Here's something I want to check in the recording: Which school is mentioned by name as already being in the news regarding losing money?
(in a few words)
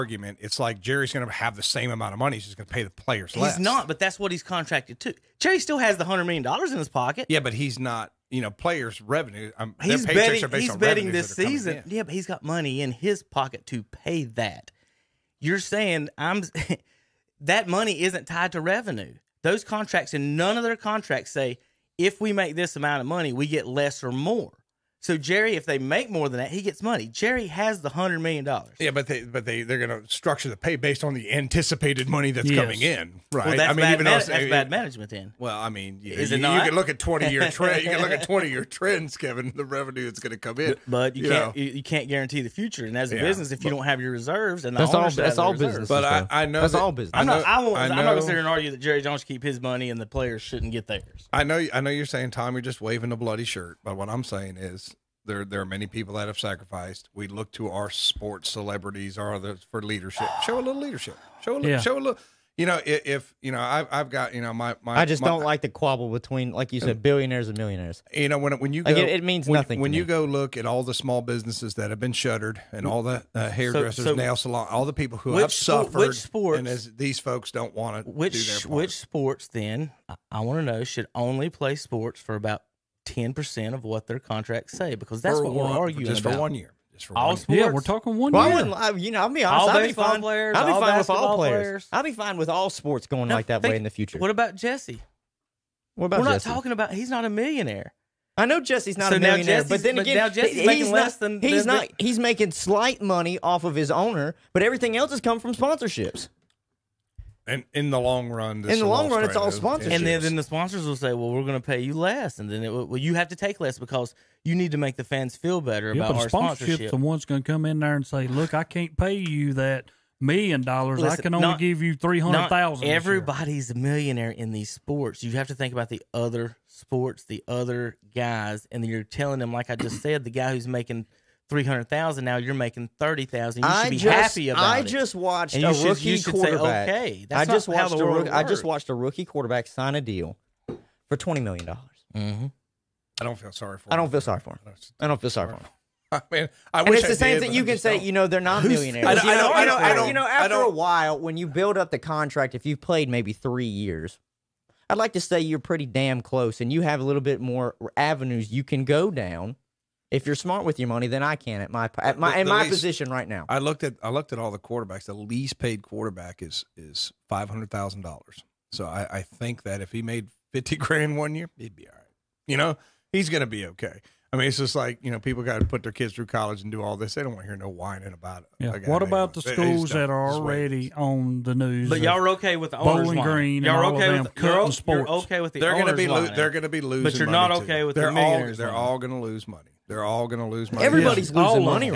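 Bowling Green.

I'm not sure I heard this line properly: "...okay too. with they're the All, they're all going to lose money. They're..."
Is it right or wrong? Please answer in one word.
right.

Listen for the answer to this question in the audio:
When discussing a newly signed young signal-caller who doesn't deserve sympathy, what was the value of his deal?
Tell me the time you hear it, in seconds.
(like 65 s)
141 s.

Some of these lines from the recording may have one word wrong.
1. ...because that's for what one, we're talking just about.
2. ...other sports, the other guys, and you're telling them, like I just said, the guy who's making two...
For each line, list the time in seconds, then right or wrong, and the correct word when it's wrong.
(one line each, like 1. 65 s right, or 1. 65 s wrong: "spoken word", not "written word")
1. 84 s wrong: "arguing", not "talking"
2. 126 s wrong: "three", not "two".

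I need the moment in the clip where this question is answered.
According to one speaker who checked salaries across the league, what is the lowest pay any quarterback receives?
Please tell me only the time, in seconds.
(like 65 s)
167 s.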